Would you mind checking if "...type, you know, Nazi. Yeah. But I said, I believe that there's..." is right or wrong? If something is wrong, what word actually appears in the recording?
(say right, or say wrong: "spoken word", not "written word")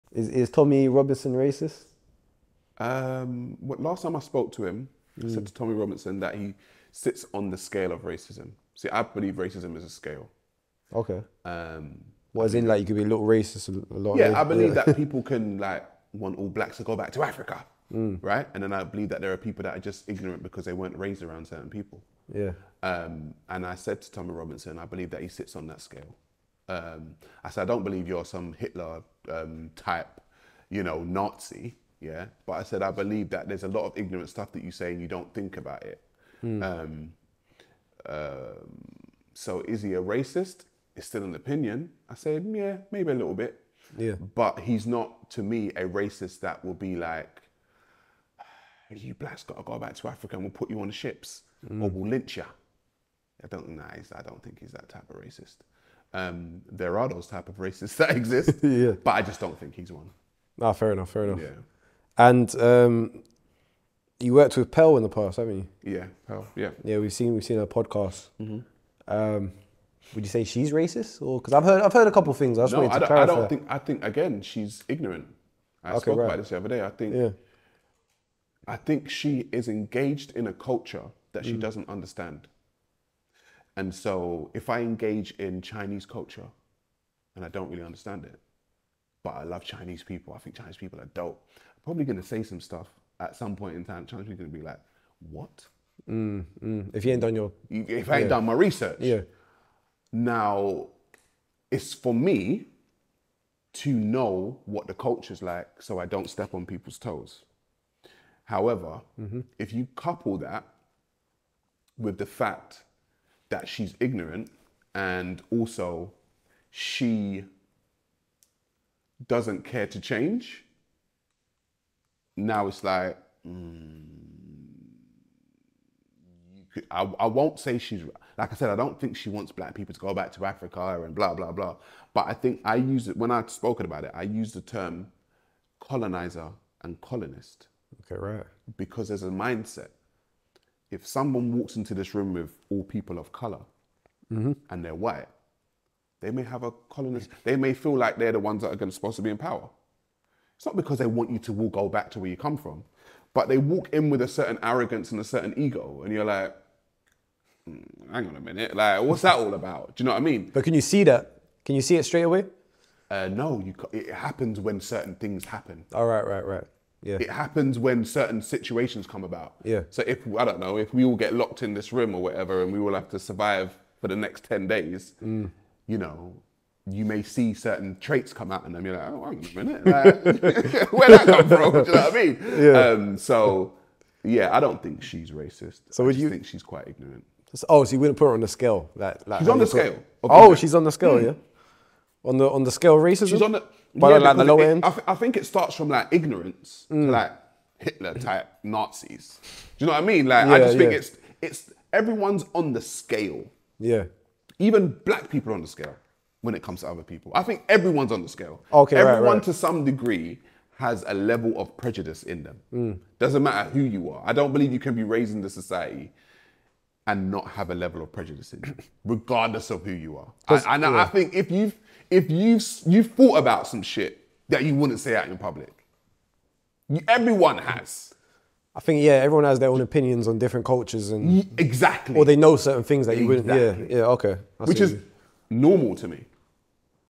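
right.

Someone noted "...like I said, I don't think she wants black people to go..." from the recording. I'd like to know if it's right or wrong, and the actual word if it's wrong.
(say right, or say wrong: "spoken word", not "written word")
right.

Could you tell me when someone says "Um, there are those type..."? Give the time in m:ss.
0:56.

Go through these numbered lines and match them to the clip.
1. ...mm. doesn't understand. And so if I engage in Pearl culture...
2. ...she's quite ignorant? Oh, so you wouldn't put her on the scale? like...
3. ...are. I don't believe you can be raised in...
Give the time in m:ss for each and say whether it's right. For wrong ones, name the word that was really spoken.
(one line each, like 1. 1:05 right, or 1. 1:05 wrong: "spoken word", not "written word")
1. 1:21 wrong: "Chinese", not "Pearl"
2. 3:06 right
3. 3:34 right.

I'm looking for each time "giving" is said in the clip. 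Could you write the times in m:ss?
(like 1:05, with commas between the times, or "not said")
not said.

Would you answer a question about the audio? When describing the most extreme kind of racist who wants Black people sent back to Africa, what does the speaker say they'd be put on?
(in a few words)
Ships.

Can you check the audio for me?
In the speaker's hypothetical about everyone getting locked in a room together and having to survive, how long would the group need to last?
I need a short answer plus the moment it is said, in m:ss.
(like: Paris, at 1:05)
10 days, at 2:54.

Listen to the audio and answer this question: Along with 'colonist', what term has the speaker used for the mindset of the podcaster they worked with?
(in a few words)
Colonizer.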